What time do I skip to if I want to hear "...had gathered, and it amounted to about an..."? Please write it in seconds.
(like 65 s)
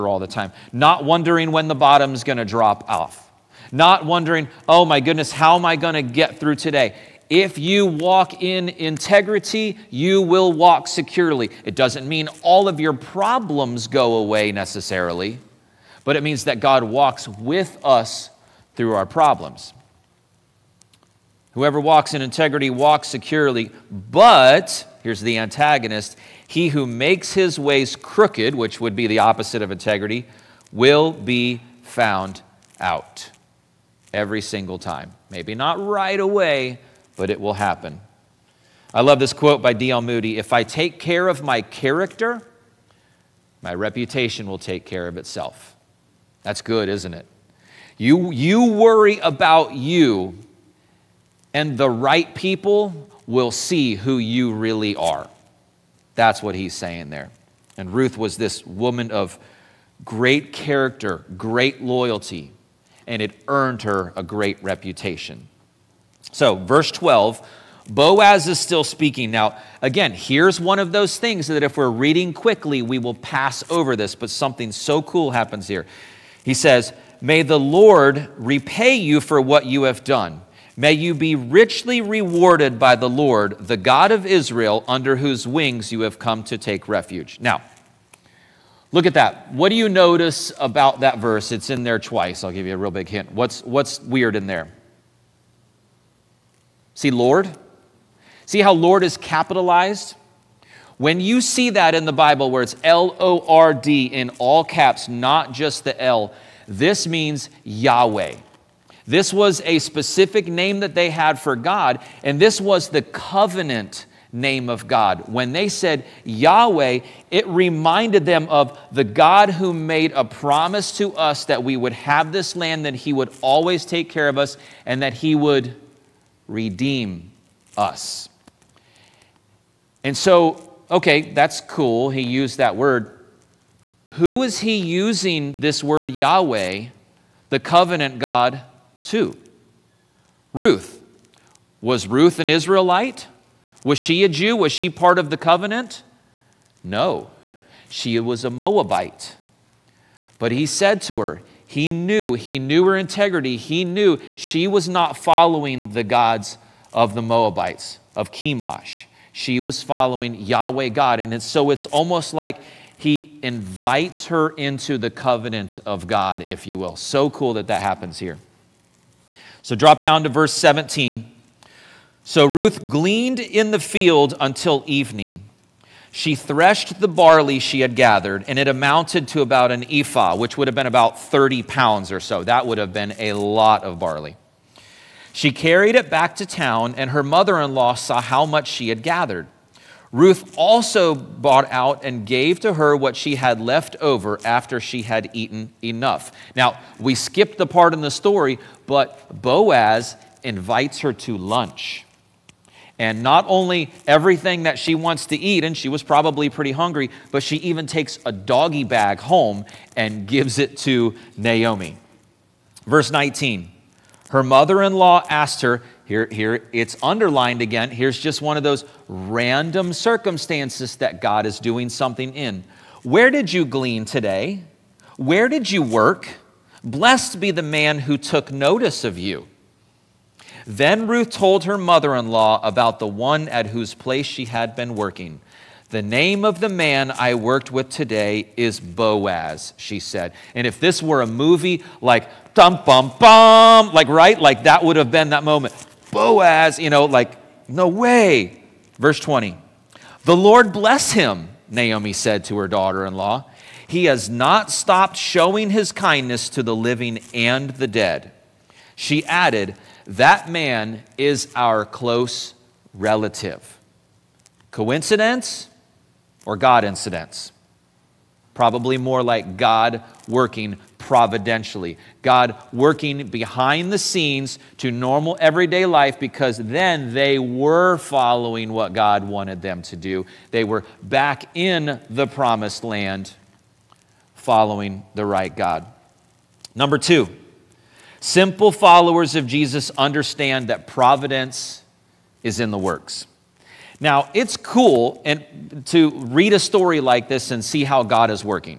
177 s.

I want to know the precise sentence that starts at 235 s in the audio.
The name of the man I worked with today is Boaz, she said.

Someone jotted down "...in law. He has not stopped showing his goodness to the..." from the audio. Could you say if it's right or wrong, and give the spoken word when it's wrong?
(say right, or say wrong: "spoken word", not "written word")
wrong: "kindness", not "goodness".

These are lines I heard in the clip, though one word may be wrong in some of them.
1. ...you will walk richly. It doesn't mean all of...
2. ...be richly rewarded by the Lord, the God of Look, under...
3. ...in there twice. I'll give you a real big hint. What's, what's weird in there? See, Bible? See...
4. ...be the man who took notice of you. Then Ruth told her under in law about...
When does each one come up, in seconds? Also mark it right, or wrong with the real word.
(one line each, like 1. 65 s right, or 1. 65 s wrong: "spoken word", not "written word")
1. 9 s wrong: "securely", not "richly"
2. 81 s wrong: "Israel", not "Look"
3. 91 s wrong: "Lord", not "Bible"
4. 227 s wrong: "mother", not "under".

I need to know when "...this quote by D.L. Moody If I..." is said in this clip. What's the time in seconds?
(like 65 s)
39 s.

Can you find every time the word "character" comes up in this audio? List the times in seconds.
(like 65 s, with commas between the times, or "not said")
41 s, 60 s.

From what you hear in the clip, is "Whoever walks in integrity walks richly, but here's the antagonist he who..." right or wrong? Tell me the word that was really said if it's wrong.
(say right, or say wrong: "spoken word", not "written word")
wrong: "securely", not "richly".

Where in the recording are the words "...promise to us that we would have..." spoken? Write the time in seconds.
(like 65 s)
120 s.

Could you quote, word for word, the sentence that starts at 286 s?
Number two, Simple followers of Jesus understand that providence is in the works.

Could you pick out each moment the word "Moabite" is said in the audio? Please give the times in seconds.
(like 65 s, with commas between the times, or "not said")
148 s, 157 s.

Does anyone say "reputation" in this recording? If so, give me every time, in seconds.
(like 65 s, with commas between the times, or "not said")
43 s, 64 s.